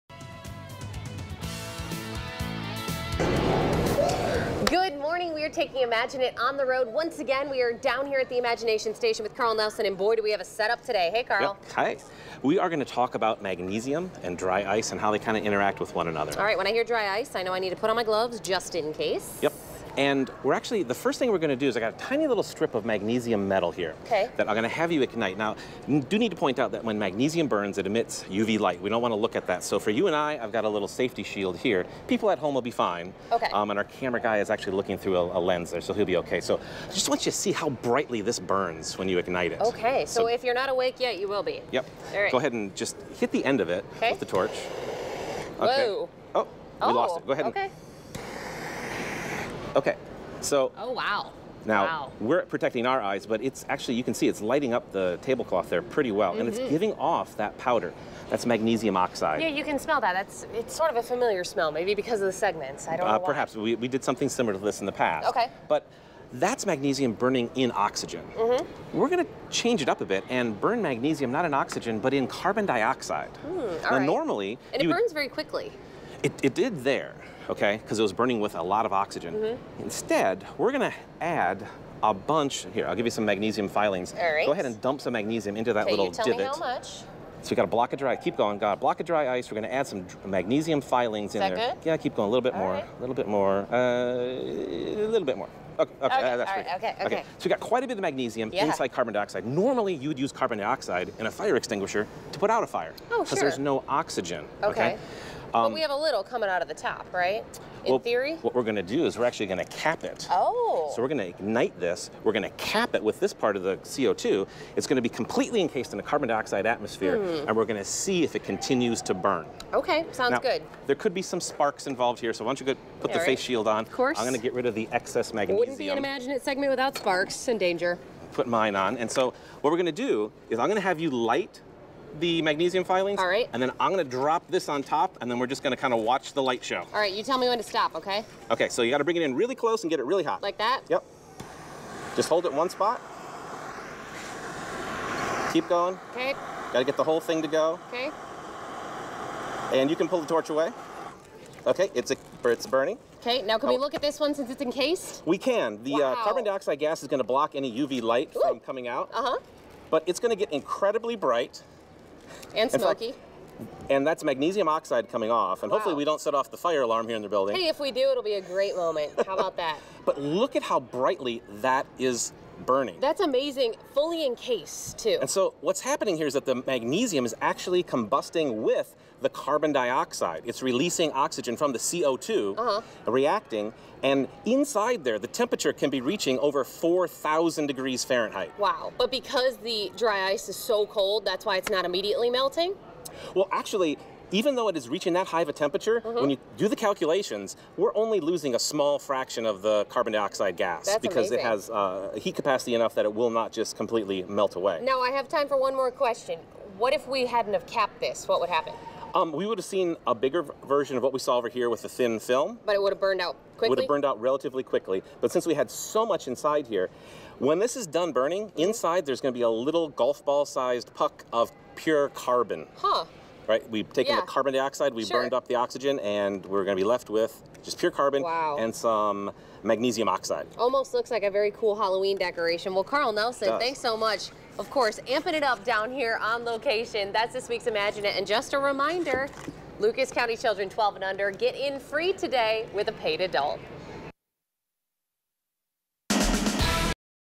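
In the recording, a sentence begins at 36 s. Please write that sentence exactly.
So I just want you to see how brightly this burns when you ignite it.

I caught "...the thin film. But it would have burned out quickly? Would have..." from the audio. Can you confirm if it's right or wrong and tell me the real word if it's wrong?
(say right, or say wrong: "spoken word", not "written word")
right.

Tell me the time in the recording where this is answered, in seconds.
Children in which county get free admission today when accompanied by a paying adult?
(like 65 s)
239 s.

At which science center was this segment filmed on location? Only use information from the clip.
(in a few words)
Imagination Station.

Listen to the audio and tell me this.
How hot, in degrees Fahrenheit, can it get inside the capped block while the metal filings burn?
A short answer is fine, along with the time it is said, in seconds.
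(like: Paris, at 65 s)
over 4,000 degrees, at 186 s.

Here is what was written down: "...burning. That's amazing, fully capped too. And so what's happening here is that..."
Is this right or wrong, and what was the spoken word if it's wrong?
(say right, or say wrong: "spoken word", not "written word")
wrong: "encased", not "capped".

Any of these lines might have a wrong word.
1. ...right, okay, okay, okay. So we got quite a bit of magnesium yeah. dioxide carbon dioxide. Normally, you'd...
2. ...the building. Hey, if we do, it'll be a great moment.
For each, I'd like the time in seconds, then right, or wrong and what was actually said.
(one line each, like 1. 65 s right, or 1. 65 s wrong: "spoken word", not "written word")
1. 96 s wrong: "inside", not "dioxide"
2. 167 s right.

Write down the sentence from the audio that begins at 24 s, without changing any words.
that I'm gonna have you ignite.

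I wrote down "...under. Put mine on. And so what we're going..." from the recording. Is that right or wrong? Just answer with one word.
wrong.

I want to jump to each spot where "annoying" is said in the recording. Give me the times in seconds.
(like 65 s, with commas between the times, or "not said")
not said.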